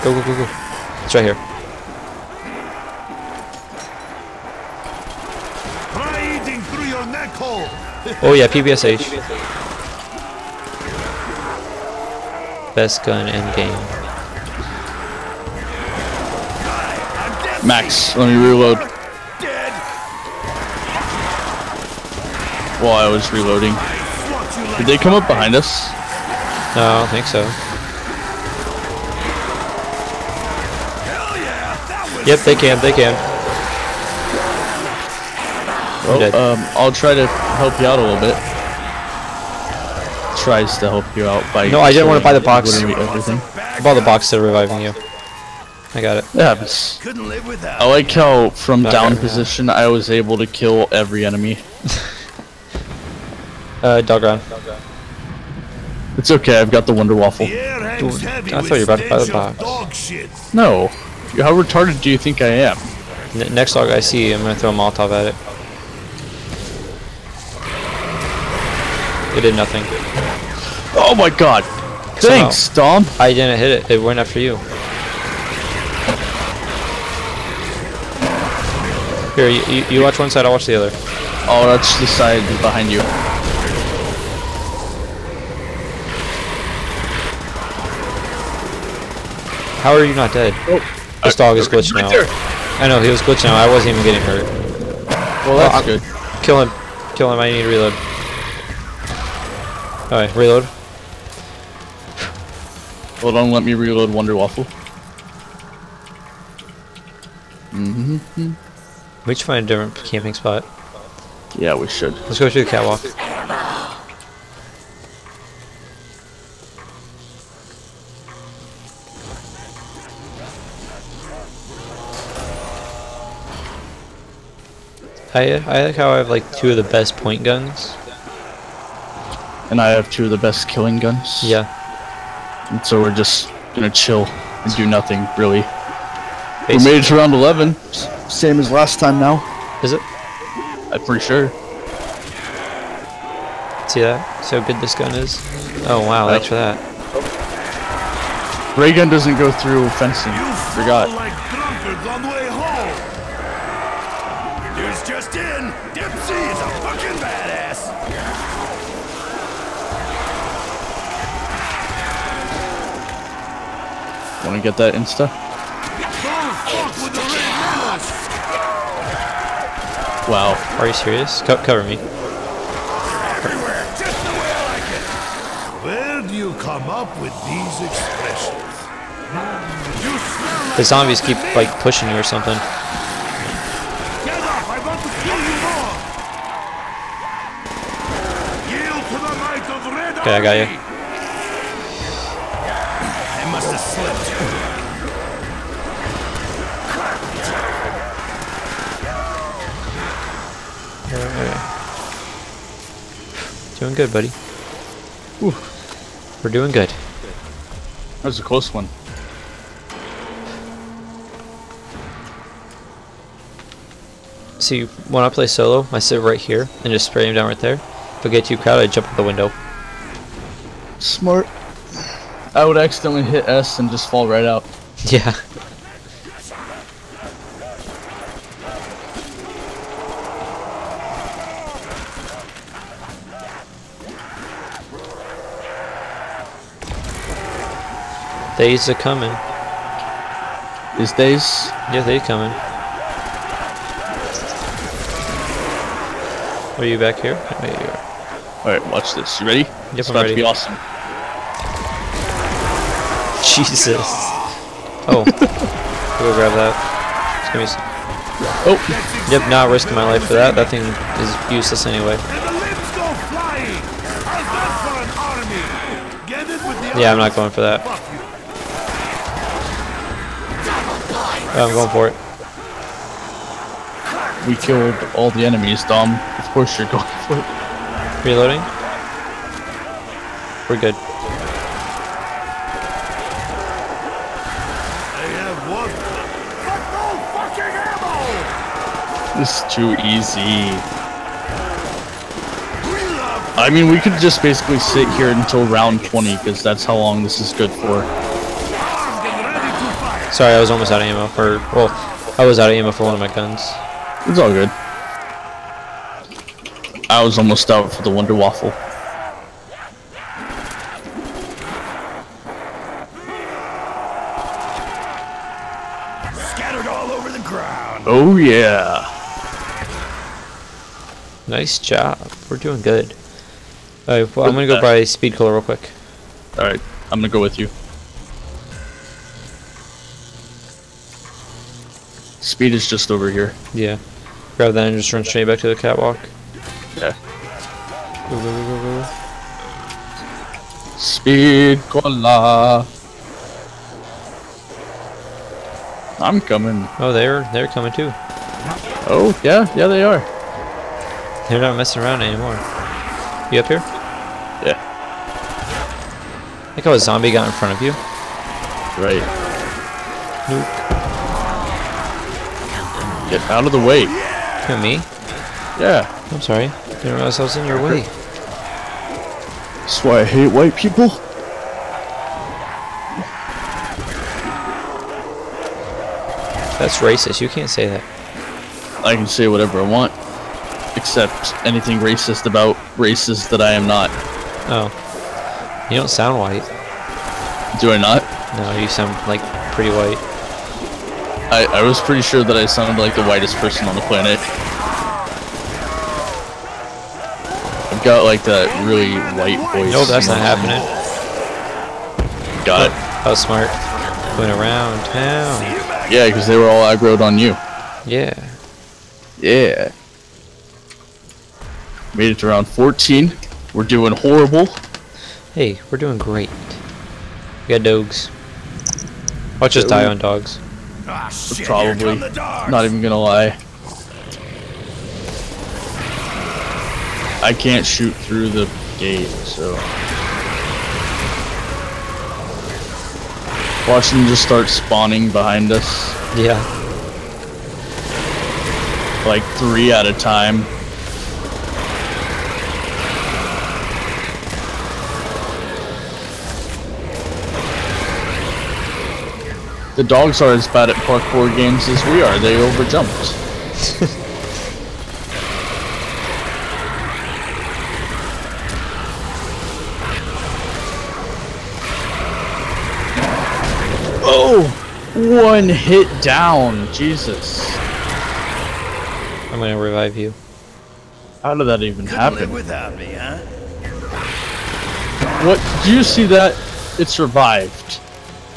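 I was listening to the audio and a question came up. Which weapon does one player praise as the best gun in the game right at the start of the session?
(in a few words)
PPSh.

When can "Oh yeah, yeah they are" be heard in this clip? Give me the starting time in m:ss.
5:49.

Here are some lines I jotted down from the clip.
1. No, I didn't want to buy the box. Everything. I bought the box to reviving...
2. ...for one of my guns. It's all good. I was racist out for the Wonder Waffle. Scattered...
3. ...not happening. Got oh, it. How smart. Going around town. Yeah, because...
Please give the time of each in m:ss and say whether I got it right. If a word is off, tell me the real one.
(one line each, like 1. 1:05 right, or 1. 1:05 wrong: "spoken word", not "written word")
1. 0:41 right
2. 5:02 wrong: "almost", not "racist"
3. 6:40 right.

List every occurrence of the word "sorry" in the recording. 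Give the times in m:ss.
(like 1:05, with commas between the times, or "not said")
5:00, 6:06.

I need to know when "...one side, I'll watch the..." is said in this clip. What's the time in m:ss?
1:20.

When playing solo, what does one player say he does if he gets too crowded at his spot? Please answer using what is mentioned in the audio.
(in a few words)
Jump out the window.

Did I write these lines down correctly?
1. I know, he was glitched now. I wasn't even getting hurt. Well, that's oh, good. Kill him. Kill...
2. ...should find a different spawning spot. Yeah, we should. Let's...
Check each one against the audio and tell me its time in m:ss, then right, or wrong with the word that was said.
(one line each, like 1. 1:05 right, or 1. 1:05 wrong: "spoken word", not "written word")
1. 1:32 right
2. 1:49 wrong: "camping", not "spawning".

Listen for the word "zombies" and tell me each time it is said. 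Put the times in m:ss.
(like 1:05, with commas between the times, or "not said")
3:00, 5:56.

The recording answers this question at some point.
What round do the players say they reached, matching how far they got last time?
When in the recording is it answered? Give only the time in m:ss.
2:17.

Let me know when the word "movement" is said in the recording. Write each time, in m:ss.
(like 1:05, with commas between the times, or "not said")
not said.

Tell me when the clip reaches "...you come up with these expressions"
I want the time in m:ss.
2:56.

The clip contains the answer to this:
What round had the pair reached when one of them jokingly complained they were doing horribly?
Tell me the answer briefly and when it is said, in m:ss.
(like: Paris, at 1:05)
14, at 6:52.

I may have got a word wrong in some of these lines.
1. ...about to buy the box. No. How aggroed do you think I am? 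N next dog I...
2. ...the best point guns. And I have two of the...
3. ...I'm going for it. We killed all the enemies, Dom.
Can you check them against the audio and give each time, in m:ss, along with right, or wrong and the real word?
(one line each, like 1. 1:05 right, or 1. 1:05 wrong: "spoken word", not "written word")
1. 0:58 wrong: "retarded", not "aggroed"
2. 2:06 right
3. 4:31 right.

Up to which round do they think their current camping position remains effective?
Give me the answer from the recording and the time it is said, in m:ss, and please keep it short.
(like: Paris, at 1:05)
20, at 4:55.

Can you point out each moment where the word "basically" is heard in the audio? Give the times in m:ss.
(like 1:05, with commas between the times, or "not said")
2:16, 4:54.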